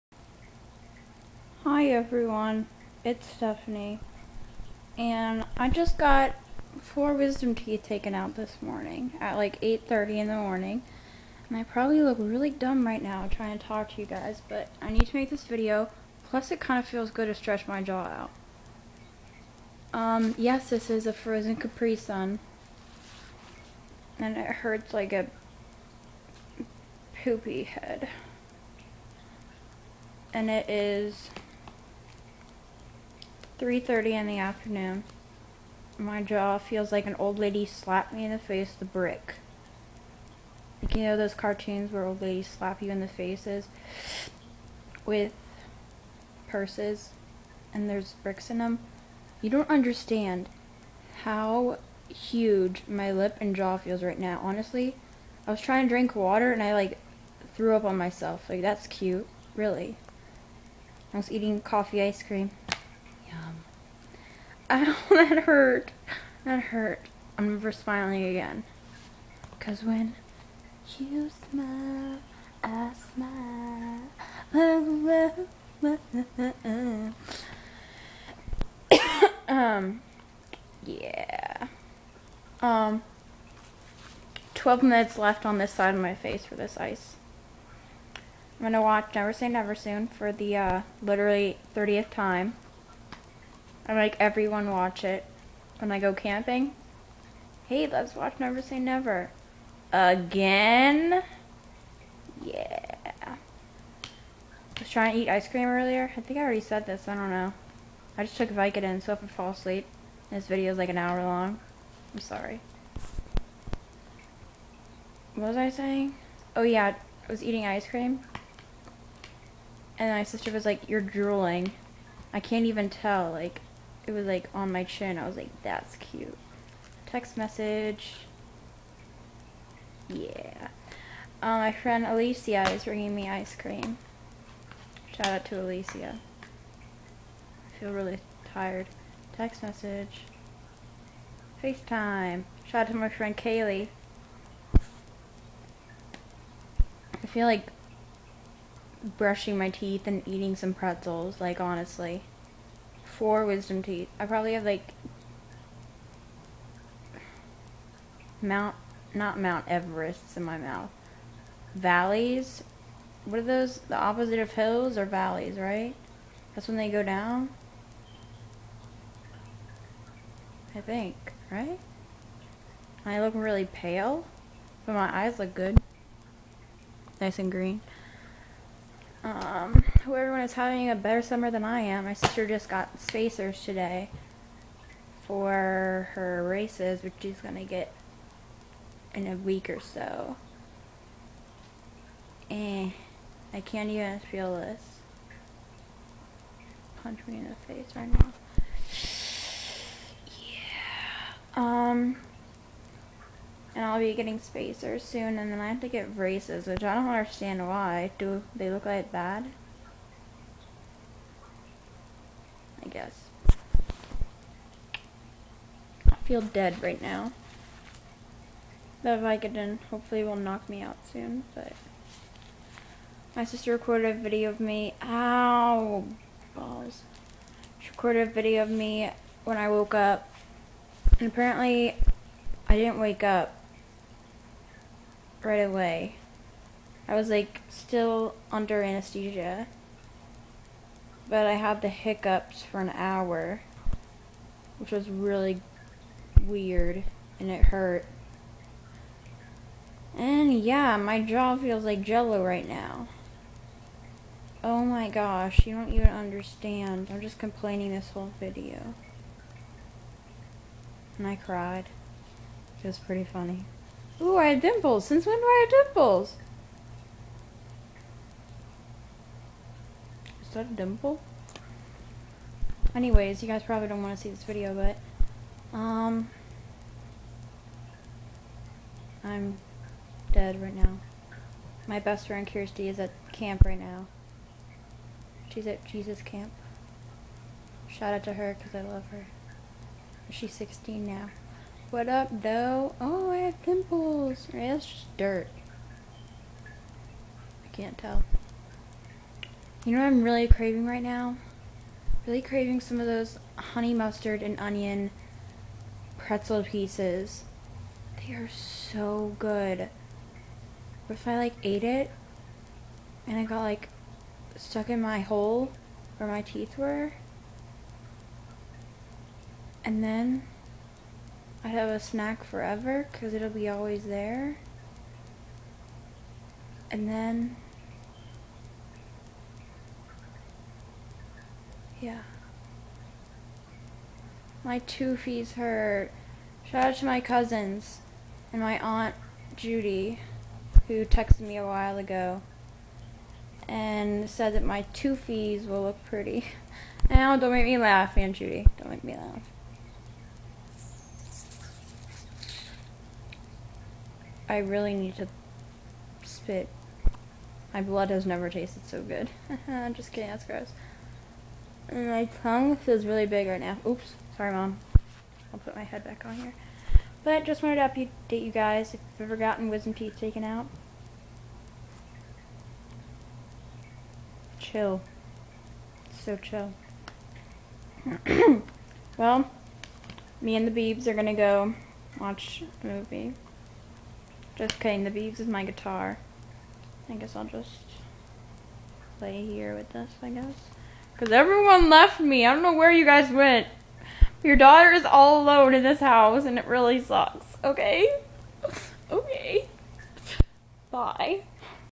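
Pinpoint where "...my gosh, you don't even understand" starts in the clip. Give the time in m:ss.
4:14.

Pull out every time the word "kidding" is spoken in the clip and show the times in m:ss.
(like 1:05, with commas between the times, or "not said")
6:00, 6:24.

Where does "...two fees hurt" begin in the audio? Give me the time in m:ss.
5:34.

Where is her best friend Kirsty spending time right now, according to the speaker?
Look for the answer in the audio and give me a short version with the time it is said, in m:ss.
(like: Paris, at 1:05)
Jesus Camp, at 4:45.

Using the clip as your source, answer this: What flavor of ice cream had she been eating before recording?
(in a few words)
Coffee.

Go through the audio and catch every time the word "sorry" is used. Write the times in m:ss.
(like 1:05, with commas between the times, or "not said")
1:52, 6:04.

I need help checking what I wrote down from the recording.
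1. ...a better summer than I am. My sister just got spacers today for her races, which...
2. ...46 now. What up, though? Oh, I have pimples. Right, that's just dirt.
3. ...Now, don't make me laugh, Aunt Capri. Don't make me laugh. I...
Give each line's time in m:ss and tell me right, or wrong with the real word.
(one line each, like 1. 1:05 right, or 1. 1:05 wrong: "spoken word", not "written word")
1. 3:00 right
2. 4:50 wrong: "16", not "46"
3. 5:47 wrong: "Judy", not "Capri".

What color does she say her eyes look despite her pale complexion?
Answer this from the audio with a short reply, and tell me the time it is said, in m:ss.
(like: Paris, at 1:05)
Green, at 2:57.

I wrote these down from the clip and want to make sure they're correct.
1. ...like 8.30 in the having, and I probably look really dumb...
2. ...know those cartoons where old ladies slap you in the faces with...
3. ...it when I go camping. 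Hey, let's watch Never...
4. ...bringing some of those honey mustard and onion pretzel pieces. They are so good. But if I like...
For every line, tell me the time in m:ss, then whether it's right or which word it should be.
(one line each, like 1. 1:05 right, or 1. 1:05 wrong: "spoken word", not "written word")
1. 0:09 wrong: "morning", not "having"
2. 0:41 right
3. 1:35 right
4. 5:02 wrong: "craving", not "bringing".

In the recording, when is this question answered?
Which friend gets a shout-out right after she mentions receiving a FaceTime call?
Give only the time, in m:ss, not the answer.
2:23.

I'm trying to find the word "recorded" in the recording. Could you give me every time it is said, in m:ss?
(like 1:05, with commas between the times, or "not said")
3:43, 3:47.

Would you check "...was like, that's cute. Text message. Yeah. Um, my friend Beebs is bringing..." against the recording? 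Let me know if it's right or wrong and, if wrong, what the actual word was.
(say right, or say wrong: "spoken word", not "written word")
wrong: "Alicia", not "Beebs".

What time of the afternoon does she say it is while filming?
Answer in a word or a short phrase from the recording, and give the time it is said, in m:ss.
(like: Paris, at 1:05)
3:30, at 0:33.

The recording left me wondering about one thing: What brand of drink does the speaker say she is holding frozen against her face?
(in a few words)
Capri Sun.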